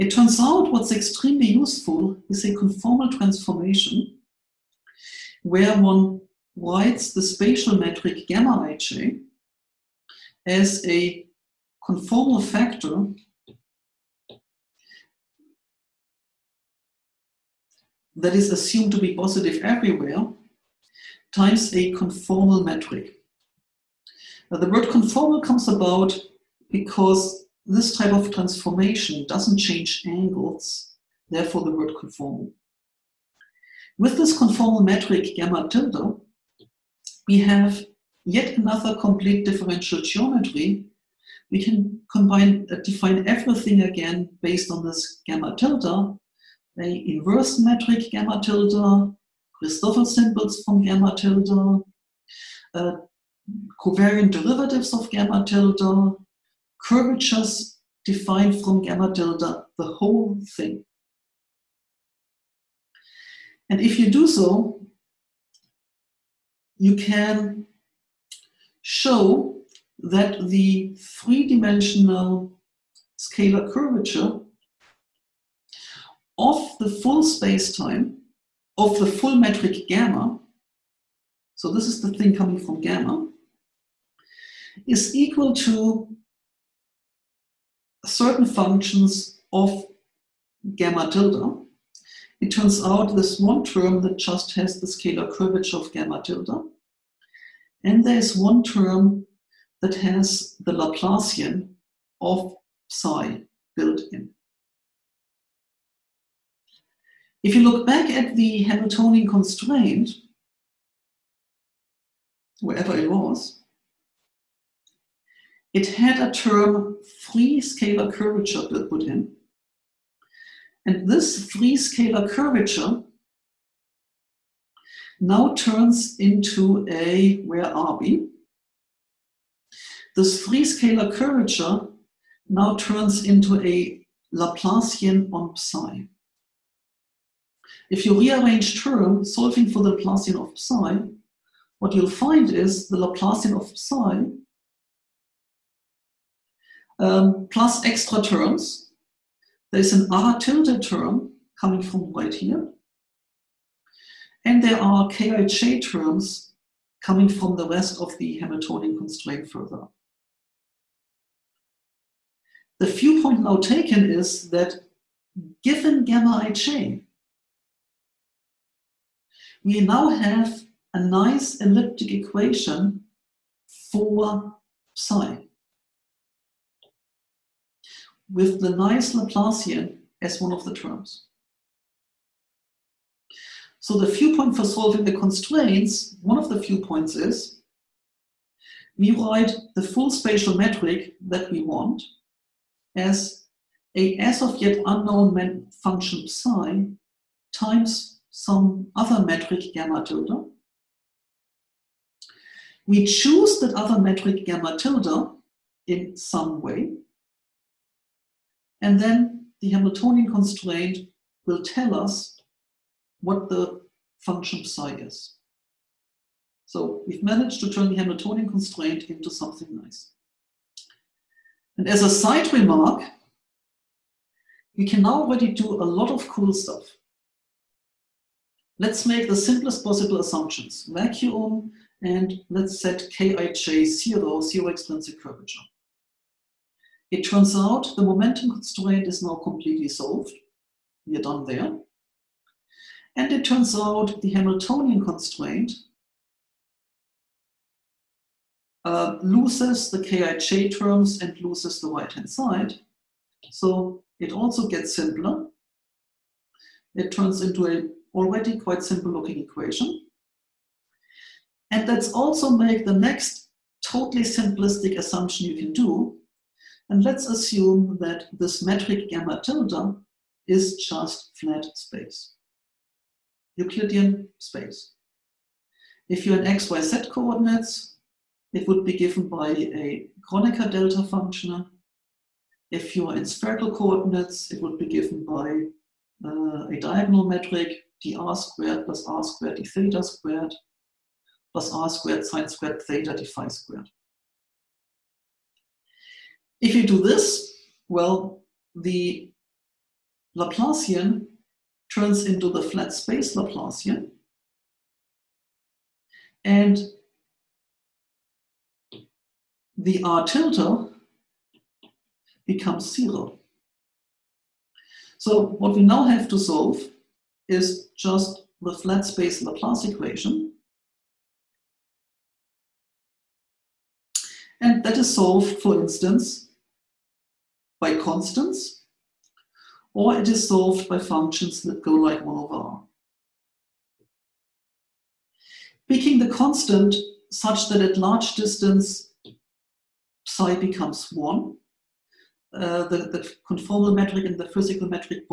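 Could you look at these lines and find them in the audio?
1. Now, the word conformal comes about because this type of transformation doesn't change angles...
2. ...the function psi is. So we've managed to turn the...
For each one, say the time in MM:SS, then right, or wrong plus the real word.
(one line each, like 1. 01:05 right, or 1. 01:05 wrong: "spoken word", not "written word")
1. 00:24 right
2. 03:33 right.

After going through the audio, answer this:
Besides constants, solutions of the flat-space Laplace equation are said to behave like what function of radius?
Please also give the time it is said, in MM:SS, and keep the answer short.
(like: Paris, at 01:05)
1 over r, at 05:32.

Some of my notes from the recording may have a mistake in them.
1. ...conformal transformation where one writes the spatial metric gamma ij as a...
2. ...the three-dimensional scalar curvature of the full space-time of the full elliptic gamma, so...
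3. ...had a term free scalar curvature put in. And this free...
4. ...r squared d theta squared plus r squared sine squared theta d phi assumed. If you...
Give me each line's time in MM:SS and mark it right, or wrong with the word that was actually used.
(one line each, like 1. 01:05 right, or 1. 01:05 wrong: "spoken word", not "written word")
1. 00:02 right
2. 01:10 wrong: "metric", not "elliptic"
3. 01:55 right
4. 04:49 wrong: "squared", not "assumed".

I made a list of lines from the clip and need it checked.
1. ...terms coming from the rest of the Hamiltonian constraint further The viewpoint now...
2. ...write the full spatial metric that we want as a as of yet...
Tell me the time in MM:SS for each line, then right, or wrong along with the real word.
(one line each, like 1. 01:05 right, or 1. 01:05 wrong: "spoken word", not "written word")
1. 02:35 right
2. 03:09 right.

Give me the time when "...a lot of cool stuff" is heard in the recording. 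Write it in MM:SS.
03:45.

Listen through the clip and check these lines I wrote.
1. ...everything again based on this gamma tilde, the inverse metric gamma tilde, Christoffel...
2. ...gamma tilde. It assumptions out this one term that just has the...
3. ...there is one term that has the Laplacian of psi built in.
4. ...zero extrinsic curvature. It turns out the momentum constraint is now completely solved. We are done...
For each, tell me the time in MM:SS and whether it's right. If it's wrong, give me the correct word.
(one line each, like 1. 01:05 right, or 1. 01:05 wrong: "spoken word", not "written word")
1. 00:43 right
2. 01:30 wrong: "turns", not "assumptions"
3. 01:38 right
4. 03:54 right.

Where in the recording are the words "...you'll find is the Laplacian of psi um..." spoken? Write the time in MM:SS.
02:21.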